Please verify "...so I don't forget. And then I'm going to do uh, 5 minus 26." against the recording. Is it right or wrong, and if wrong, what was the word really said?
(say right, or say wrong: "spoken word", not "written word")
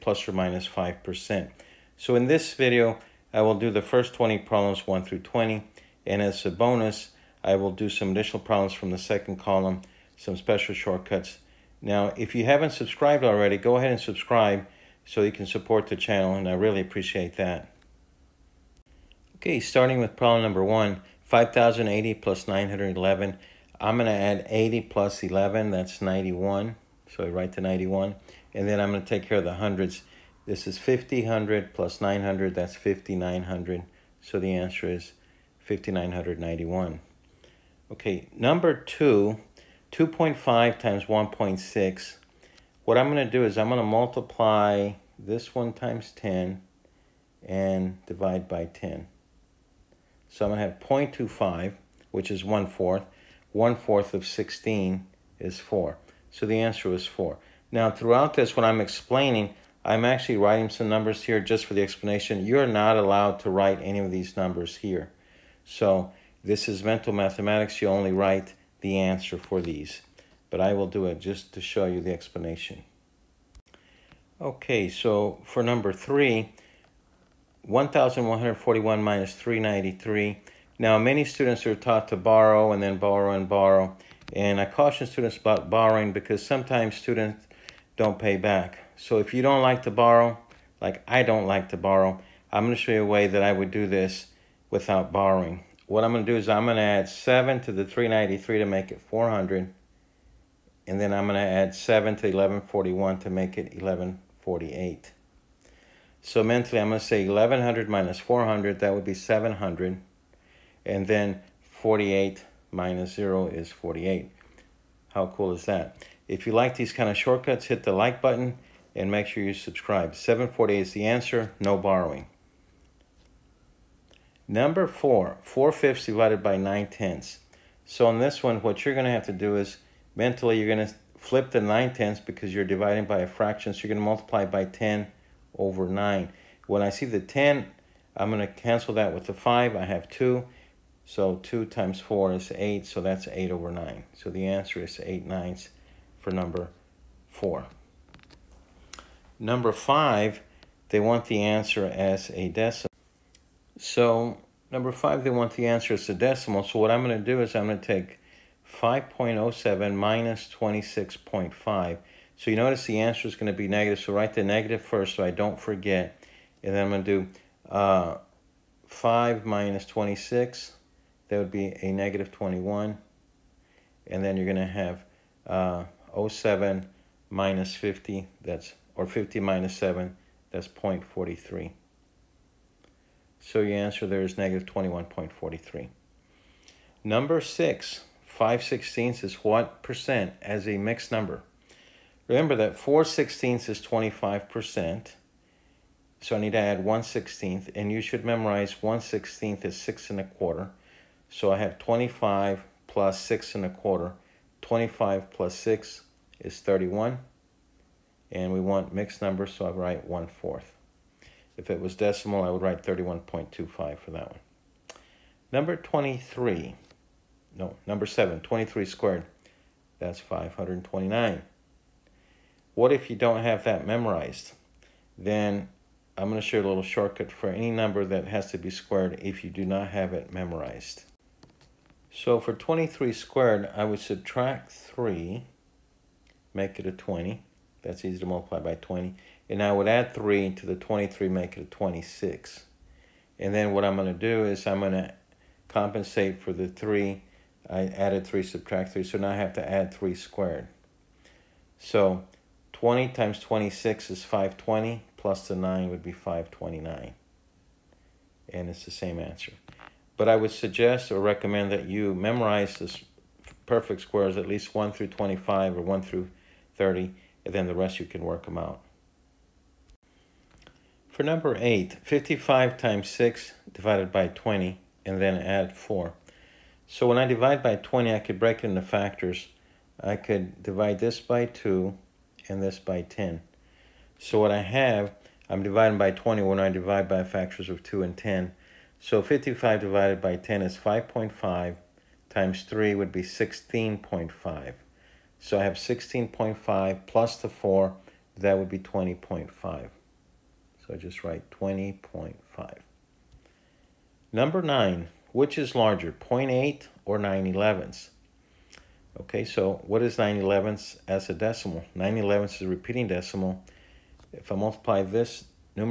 right.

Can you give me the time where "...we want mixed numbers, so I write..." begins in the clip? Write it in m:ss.
3:28.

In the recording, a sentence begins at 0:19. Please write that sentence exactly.
Okay, starting with problem number one, 5,080 plus 911.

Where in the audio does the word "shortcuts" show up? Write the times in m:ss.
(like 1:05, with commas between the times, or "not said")
0:10, 1:57, 3:46.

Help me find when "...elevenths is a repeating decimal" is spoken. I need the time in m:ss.
5:12.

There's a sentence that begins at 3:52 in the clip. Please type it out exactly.
So for 23 squared, I would subtract 3, make it a 20.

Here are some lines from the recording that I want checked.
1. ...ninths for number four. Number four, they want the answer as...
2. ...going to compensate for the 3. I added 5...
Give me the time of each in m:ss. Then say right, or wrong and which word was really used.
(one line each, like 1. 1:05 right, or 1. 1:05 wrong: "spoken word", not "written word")
1. 2:25 wrong: "five", not "four"
2. 4:04 wrong: "3", not "5".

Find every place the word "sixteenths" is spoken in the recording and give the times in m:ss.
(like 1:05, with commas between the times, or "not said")
3:08, 3:13.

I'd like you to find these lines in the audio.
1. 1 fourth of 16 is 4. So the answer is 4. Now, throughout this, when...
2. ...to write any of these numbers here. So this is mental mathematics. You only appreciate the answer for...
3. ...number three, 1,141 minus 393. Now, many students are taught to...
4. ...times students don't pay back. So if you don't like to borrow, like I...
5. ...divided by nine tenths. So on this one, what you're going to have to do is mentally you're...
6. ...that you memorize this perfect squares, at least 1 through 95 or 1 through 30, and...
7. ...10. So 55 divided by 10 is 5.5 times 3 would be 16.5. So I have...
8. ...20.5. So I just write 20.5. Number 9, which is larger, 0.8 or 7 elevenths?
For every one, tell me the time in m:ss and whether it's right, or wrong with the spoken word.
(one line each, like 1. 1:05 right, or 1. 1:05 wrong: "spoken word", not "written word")
1. 0:53 right
2. 1:03 wrong: "write", not "appreciate"
3. 1:15 right
4. 1:26 wrong: "sometimes", not "times"
5. 2:06 right
6. 4:21 wrong: "25", not "95"
7. 4:48 right
8. 4:58 wrong: "9", not "7".